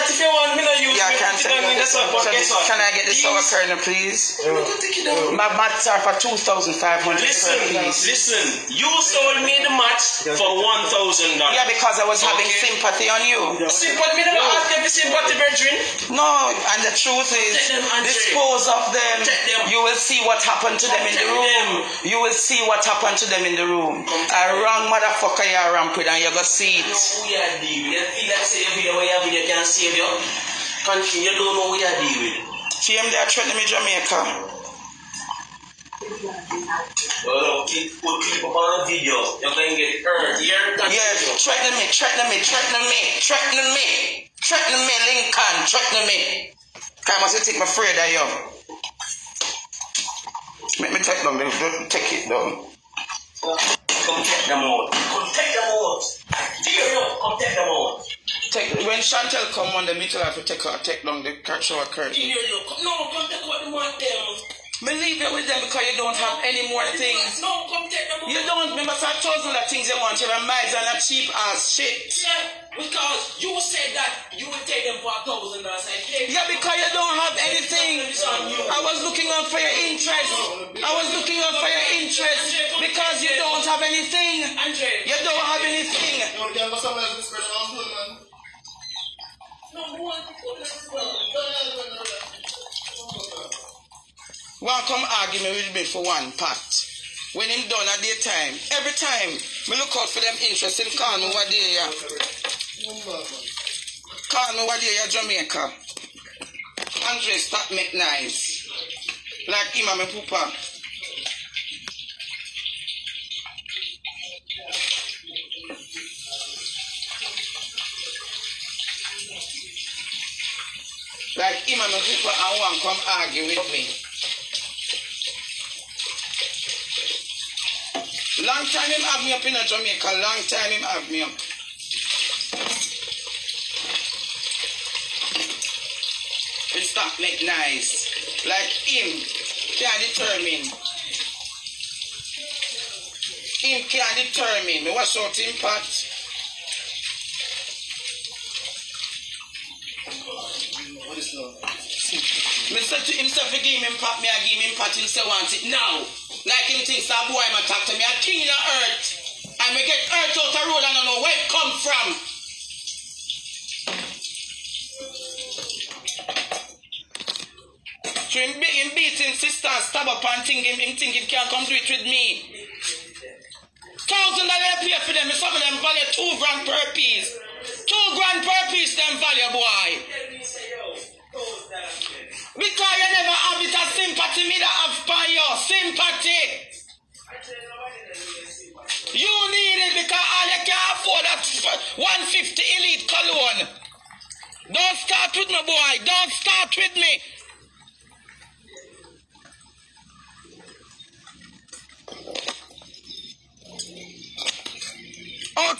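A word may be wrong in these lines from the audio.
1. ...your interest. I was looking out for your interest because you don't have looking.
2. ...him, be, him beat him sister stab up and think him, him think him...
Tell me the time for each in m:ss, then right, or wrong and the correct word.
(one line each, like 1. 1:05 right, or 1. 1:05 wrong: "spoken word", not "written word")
1. 1:19 wrong: "anything", not "looking"
2. 2:48 right.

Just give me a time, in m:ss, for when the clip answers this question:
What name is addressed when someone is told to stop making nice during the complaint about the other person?
1:47.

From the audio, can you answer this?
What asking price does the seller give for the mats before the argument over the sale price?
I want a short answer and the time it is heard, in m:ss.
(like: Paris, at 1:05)
2500, at 0:06.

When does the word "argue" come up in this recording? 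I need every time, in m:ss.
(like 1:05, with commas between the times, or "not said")
1:35, 2:03.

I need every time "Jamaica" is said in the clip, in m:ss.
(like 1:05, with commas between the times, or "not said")
0:33, 1:45, 2:09.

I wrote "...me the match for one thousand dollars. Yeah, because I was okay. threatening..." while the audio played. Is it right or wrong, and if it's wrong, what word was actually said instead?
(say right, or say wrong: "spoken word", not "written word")
wrong: "having", not "threatening".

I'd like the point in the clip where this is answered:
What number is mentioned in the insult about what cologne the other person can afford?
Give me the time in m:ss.
3:11.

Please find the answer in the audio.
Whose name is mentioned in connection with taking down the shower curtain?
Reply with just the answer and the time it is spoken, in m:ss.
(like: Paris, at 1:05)
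Chantel, at 0:59.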